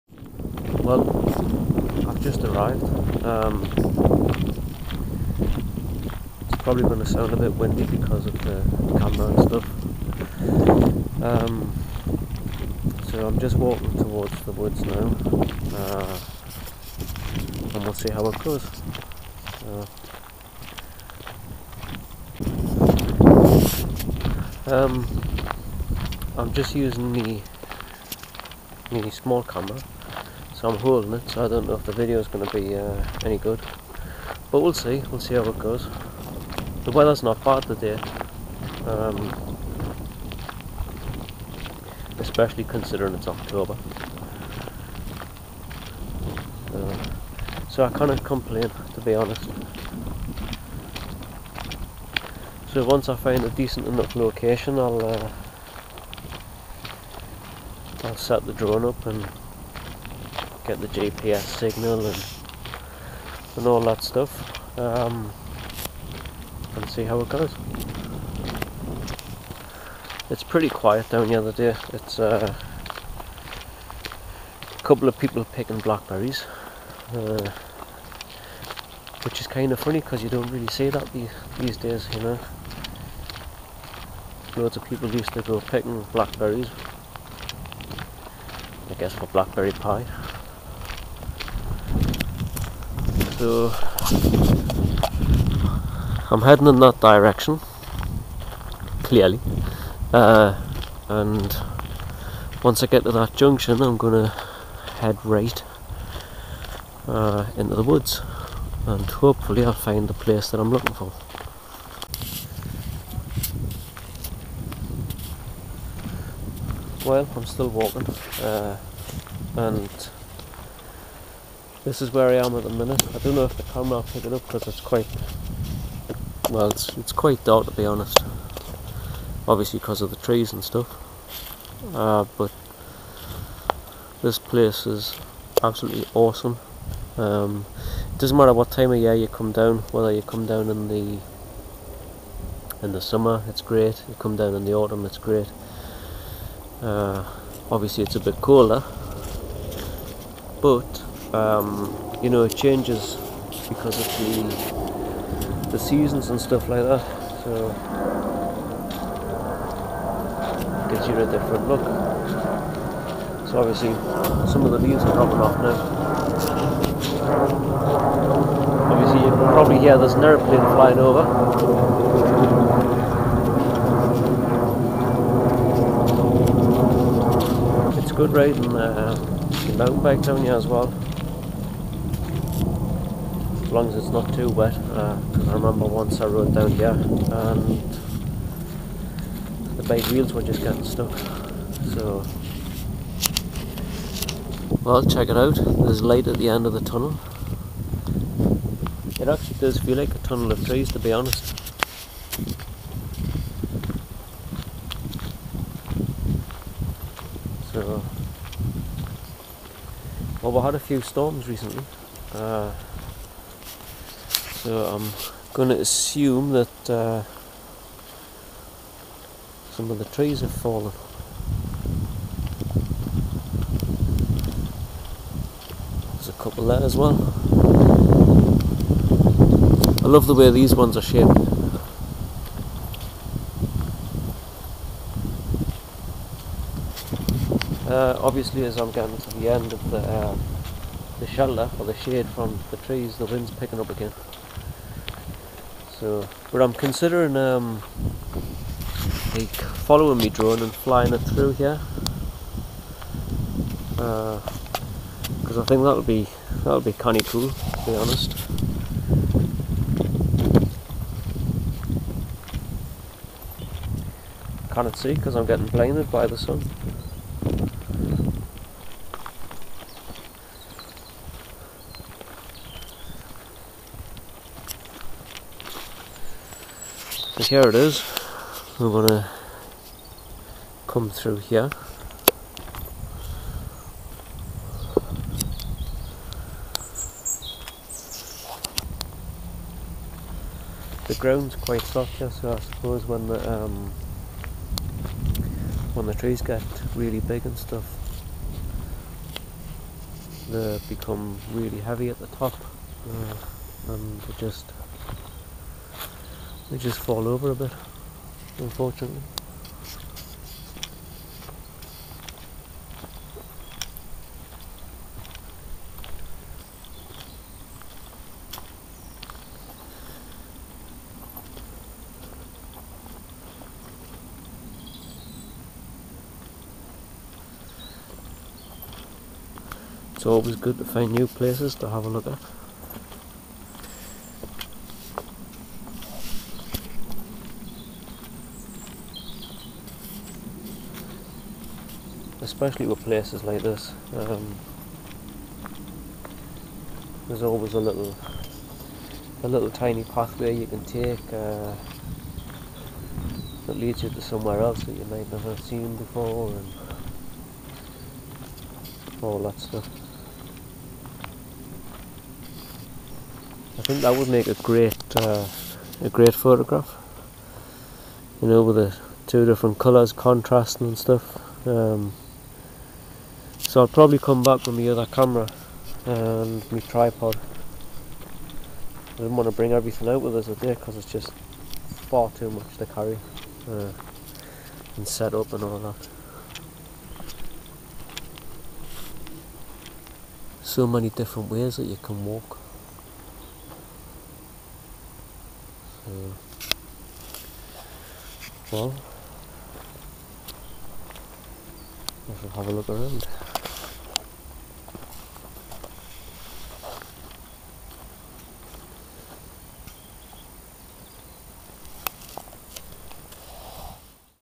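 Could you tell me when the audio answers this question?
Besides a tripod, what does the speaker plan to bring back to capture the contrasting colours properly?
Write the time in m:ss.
6:14.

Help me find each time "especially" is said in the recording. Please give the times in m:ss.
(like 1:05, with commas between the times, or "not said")
0:42, 5:42.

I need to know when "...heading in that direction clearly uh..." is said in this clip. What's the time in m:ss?
1:36.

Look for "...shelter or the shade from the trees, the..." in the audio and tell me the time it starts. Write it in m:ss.
4:01.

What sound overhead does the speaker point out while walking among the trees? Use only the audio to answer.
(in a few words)
An airplane.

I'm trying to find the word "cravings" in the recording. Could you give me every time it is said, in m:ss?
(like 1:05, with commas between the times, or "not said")
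not said.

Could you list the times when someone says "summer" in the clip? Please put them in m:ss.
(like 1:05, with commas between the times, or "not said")
2:23.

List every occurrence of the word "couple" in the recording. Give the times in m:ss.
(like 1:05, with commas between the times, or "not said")
1:14, 3:46.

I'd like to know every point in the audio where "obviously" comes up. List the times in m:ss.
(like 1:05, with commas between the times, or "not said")
2:09, 2:27, 2:43, 2:48, 3:58.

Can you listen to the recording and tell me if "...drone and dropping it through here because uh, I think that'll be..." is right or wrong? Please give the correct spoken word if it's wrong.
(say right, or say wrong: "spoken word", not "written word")
wrong: "flying", not "dropping".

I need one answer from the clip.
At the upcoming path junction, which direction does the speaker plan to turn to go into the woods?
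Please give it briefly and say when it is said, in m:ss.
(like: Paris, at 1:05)
Right, at 1:45.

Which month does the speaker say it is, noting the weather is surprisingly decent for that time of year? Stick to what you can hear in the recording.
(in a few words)
October.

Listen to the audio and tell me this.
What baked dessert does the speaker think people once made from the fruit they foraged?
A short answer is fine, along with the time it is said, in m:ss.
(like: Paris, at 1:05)
Blackberry pie, at 1:29.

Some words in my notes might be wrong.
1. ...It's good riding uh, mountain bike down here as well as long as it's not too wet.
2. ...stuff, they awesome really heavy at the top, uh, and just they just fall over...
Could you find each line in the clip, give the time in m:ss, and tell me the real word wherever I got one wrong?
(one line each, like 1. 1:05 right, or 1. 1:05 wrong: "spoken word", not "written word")
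1. 2:58 right
2. 4:57 wrong: "become", not "awesome".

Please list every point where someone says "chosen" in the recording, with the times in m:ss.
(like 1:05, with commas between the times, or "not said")
not said.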